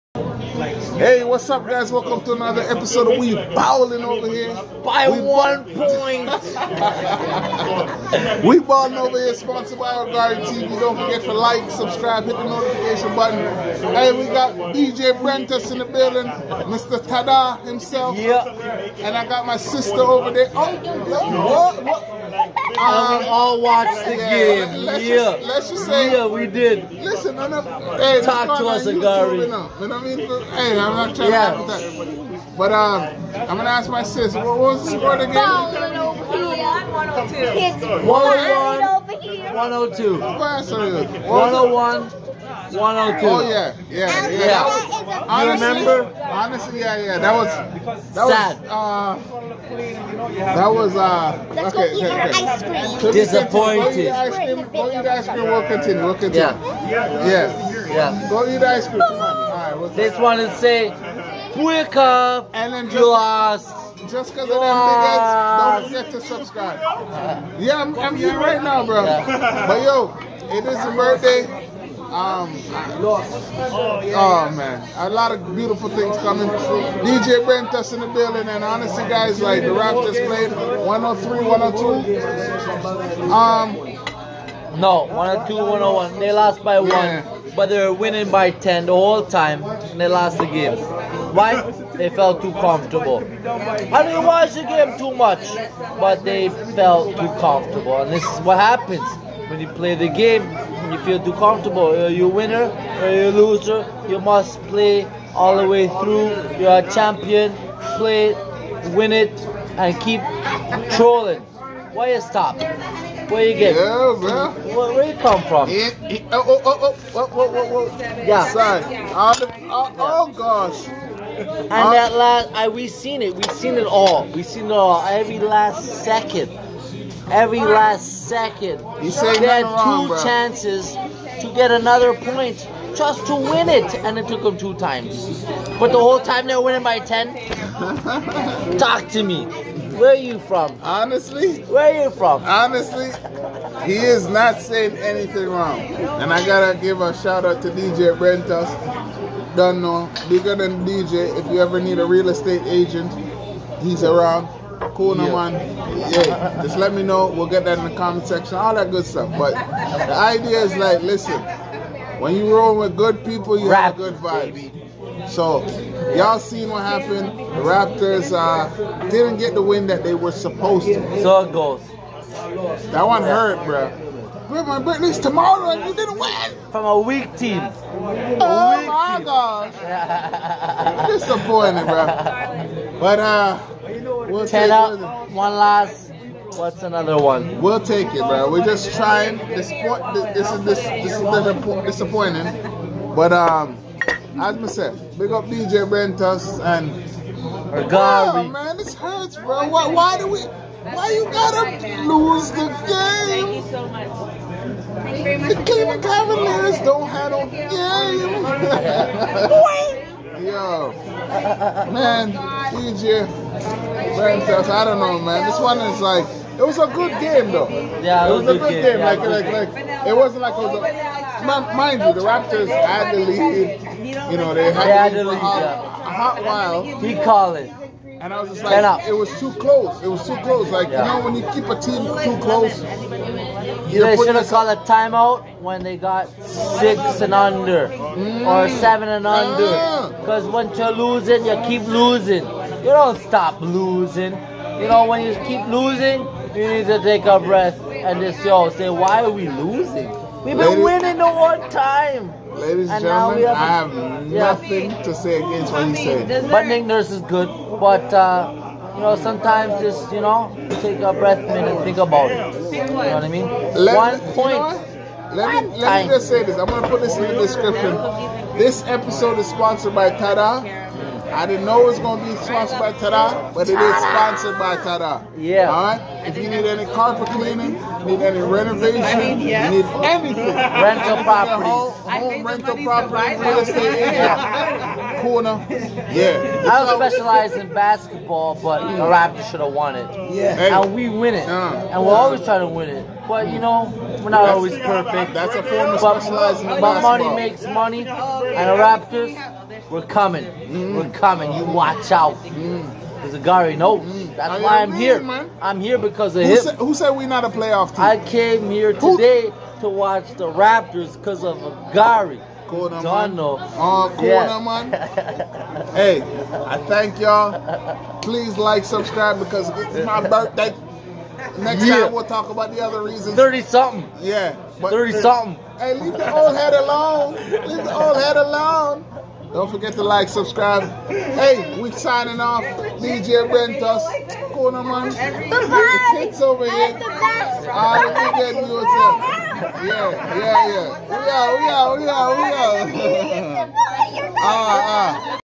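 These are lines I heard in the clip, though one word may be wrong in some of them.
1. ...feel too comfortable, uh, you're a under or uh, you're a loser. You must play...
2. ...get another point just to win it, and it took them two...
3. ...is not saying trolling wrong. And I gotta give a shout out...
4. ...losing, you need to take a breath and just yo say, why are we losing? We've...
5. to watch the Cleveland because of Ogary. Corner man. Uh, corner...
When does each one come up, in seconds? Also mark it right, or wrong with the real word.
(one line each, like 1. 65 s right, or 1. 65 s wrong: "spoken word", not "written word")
1. 100 s wrong: "winner", not "under"
2. 131 s right
3. 143 s wrong: "anything", not "trolling"
4. 245 s right
5. 309 s wrong: "Raptors", not "Cleveland".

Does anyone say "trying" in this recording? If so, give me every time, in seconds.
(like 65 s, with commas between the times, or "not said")
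31 s, 188 s, 292 s.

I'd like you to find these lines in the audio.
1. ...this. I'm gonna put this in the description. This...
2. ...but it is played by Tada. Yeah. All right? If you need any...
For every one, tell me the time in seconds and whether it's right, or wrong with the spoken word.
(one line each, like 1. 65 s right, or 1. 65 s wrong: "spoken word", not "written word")
1. 266 s right
2. 273 s wrong: "sponsored", not "played".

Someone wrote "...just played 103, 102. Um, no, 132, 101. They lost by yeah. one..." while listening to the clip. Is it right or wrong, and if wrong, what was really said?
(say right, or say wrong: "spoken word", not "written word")
wrong: "102", not "132".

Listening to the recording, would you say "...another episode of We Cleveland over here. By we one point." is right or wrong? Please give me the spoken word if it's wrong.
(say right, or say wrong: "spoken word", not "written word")
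wrong: "Balling", not "Cleveland".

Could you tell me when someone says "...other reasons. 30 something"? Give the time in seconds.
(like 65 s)
322 s.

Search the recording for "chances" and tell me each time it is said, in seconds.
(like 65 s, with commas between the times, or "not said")
130 s.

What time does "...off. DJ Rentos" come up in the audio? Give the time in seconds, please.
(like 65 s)
332 s.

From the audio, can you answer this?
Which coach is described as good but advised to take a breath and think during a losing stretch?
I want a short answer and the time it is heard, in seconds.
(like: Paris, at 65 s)
Nick Nurse, at 256 s.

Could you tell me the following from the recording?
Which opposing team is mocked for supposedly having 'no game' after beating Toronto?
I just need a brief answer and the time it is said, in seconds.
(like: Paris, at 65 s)
Cleveland Cavaliers, at 205 s.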